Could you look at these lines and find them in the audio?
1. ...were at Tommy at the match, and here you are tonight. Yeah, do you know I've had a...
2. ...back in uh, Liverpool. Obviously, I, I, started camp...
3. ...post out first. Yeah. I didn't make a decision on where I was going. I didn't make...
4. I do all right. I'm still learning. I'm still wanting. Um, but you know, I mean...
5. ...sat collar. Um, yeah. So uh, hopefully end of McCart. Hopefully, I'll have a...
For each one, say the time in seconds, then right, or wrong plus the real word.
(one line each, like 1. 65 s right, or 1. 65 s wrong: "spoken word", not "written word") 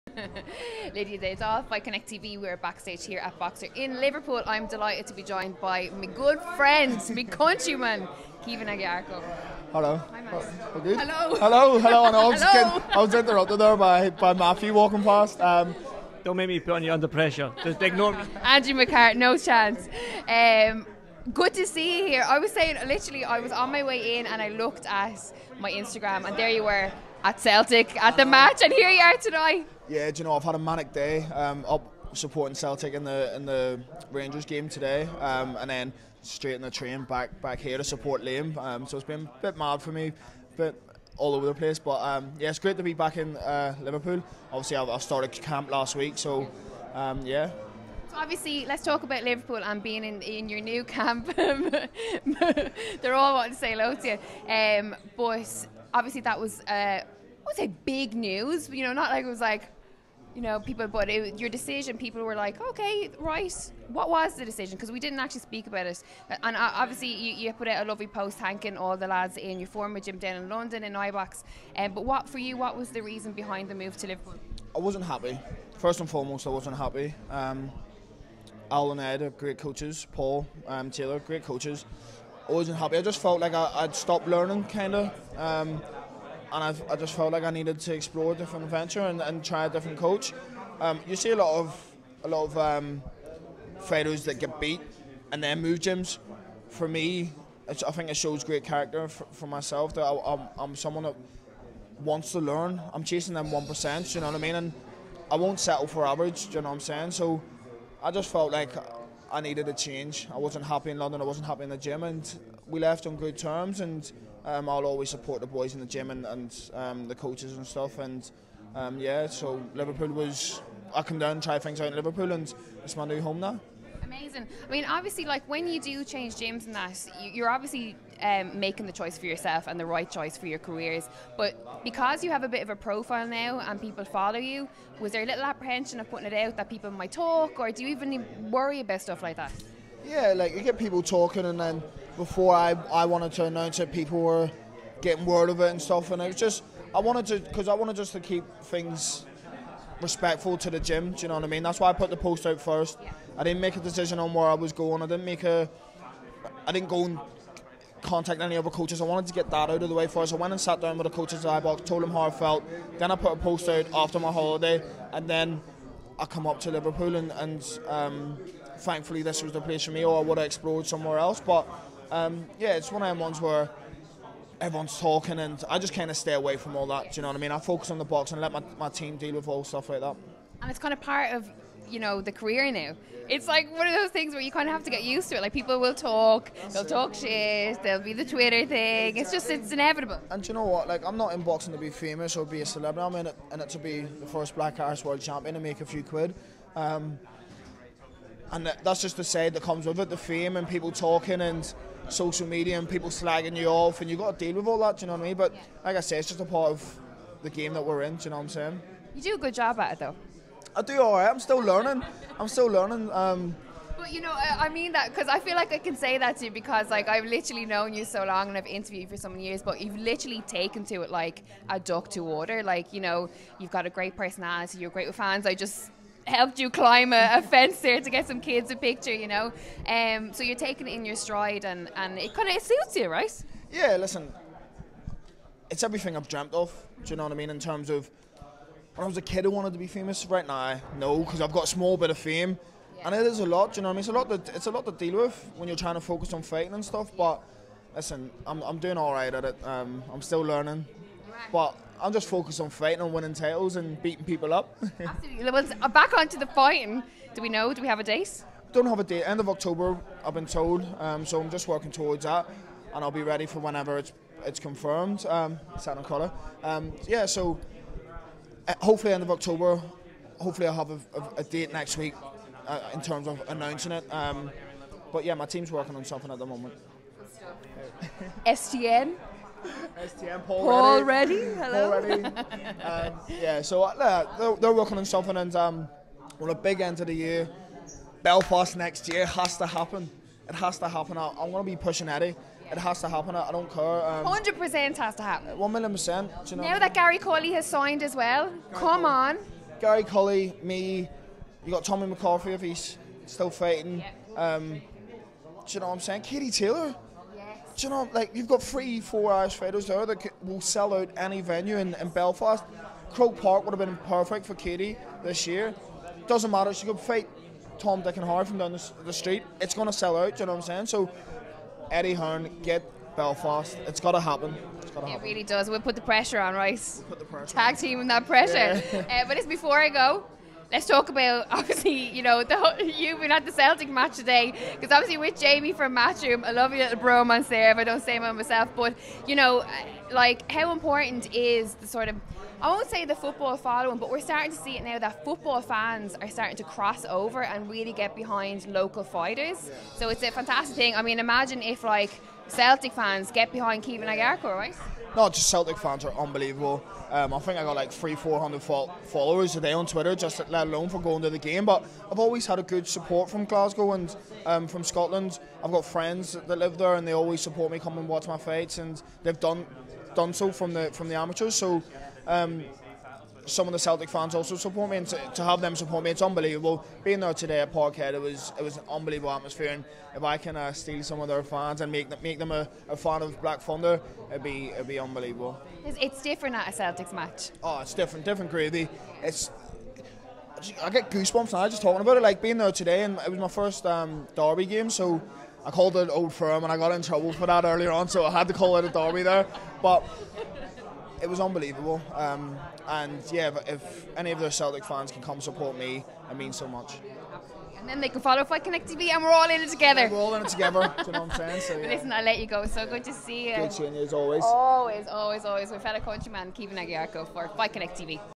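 1. 26 s wrong: "Celtic", not "Tommy"
2. 42 s right
3. 152 s right
4. 210 s wrong: "learning", not "wanting"
5. 265 s wrong: "October", not "McCart".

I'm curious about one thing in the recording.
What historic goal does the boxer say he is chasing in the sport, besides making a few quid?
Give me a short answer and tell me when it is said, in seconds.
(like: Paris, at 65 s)
First black Irish world champion, at 194 s.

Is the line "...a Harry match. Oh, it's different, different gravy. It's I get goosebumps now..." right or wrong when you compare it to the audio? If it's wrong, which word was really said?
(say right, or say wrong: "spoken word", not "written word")
wrong: "Celtics", not "Harry".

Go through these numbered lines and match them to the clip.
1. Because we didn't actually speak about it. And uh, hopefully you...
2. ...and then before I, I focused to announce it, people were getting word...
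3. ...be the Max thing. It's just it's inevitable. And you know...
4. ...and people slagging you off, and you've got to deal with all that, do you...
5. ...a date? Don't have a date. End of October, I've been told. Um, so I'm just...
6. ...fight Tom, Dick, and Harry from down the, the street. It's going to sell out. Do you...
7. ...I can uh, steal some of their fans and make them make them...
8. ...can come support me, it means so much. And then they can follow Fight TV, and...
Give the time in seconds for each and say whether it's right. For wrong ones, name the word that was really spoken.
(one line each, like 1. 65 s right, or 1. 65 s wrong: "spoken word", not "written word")
1. 64 s wrong: "obviously", not "hopefully"
2. 141 s wrong: "wanted", not "focused"
3. 188 s wrong: "Twitter", not "Max"
4. 202 s right
5. 257 s right
6. 316 s right
7. 380 s right
8. 405 s right.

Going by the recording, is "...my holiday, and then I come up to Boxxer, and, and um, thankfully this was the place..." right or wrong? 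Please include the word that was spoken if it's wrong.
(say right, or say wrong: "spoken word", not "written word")
wrong: "Liverpool", not "Boxxer".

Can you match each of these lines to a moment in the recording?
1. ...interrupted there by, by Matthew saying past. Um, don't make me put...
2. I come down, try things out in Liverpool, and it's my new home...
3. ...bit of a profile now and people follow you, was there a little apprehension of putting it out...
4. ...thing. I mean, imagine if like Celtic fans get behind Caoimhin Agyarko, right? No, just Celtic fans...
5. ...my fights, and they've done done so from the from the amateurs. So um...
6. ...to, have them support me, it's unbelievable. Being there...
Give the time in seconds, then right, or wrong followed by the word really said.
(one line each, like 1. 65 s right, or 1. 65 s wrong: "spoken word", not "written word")
1. 13 s wrong: "walking", not "saying"
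2. 120 s right
3. 132 s right
4. 350 s right
5. 368 s right
6. 375 s right.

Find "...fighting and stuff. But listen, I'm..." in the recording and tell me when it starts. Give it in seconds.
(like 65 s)
246 s.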